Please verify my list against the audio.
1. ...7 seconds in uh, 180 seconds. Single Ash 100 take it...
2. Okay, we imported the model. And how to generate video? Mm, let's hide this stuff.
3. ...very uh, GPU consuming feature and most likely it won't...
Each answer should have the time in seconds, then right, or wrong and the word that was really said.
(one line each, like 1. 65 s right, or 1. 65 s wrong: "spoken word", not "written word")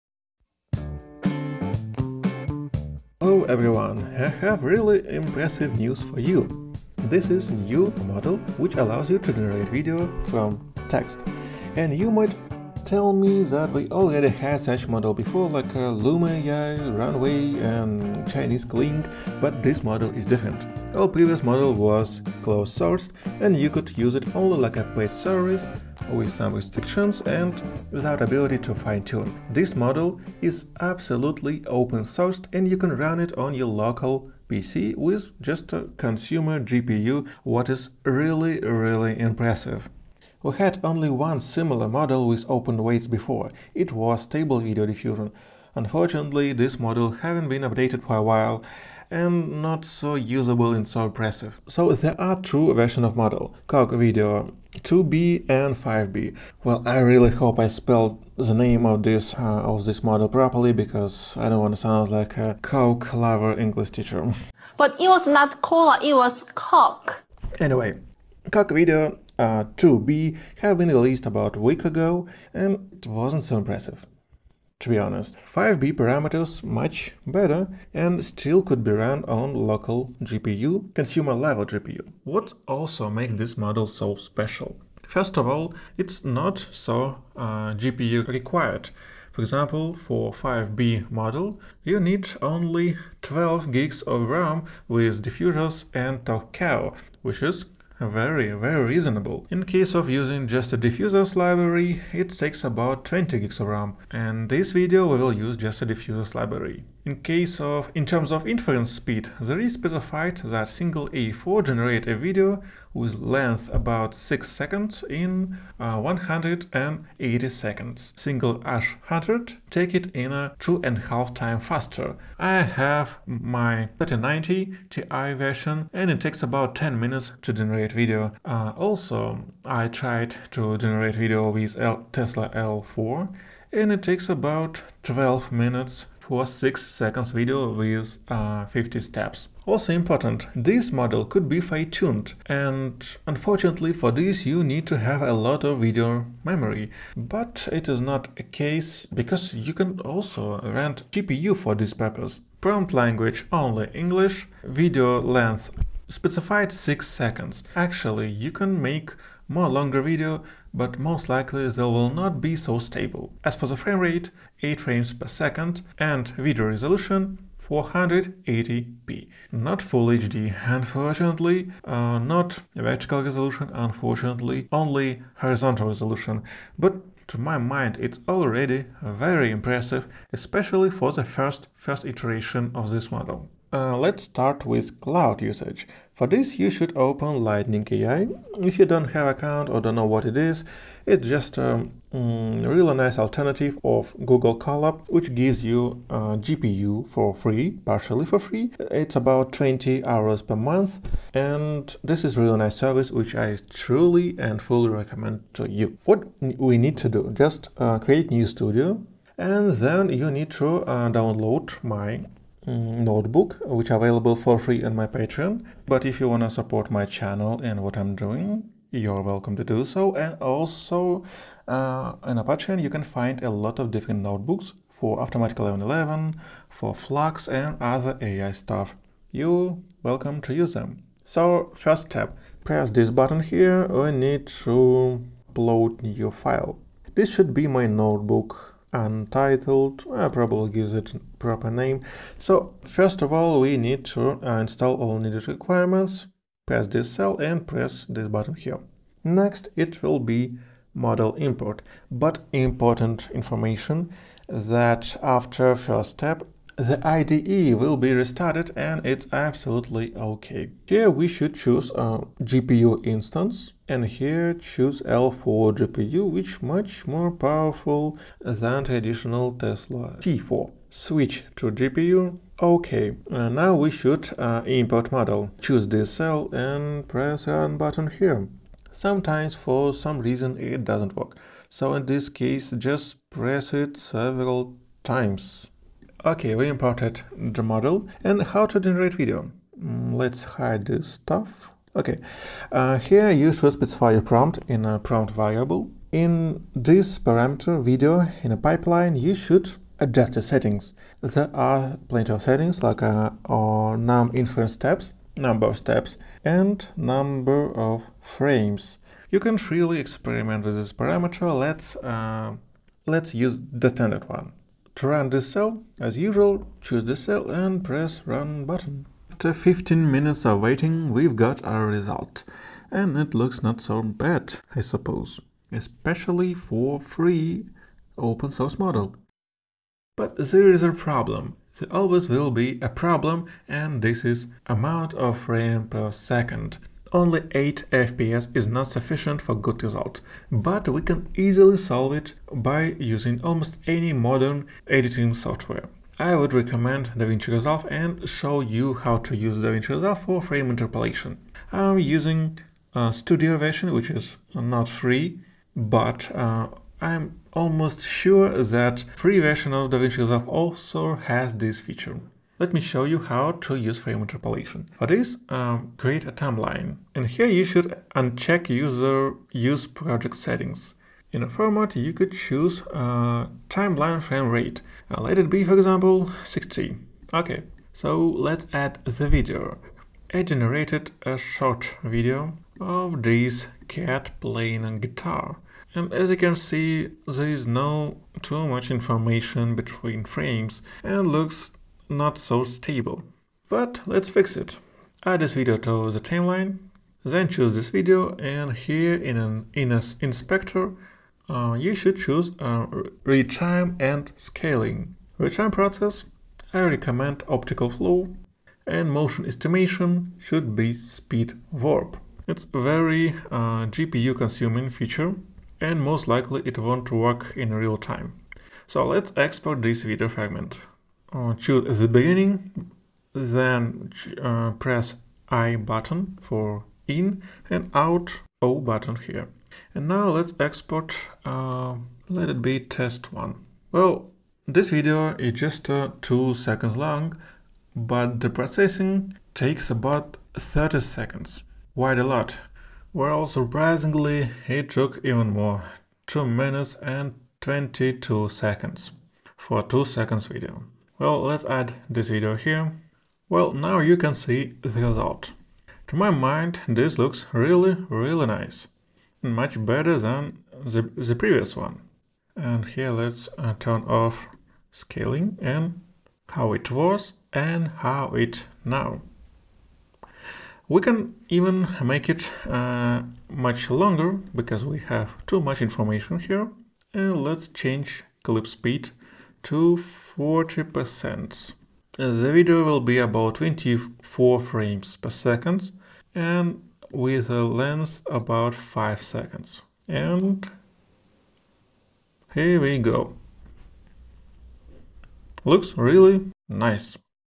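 1. 114 s wrong: "6", not "7"
2. 286 s right
3. 412 s right.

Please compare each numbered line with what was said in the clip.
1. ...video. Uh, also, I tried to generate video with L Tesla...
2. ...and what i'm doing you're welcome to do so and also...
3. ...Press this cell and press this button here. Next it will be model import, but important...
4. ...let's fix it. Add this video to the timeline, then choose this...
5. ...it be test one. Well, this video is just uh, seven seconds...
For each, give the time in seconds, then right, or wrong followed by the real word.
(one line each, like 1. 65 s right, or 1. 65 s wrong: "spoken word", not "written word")
1. 127 s right
2. 217 s right
3. 246 s right
4. 394 s right
5. 432 s wrong: "two", not "seven".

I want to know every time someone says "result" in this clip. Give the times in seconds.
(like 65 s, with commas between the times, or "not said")
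321 s, 339 s, 455 s.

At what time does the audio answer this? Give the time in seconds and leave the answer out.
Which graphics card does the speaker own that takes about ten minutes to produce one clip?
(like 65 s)
123 s.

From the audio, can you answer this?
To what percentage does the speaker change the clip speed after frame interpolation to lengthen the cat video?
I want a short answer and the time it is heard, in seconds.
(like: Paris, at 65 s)
40%, at 480 s.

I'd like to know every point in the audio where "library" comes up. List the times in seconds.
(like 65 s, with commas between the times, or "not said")
101 s, 106 s.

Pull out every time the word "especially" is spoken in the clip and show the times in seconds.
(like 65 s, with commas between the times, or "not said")
180 s, 325 s.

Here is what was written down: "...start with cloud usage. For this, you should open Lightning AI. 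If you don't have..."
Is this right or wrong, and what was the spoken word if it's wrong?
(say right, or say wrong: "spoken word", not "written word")
right.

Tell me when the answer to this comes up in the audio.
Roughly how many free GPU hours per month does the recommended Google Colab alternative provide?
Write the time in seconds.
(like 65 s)
199 s.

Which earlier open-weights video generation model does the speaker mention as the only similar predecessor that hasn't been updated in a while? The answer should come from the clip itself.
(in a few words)
Stable Video Diffusion.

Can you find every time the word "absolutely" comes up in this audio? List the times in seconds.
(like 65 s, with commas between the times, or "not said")
30 s, 259 s.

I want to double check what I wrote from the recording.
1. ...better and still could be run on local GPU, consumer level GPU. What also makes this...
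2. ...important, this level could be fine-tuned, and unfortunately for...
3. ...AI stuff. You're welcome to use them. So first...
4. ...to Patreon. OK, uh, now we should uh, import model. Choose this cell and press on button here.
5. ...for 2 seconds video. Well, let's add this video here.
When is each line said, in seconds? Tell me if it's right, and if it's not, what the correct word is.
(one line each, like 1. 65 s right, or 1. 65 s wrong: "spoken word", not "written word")
1. 77 s right
2. 139 s wrong: "model", not "level"
3. 228 s right
4. 271 s wrong: "GPU", not "Patreon"
5. 449 s right.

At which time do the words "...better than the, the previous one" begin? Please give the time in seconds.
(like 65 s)
459 s.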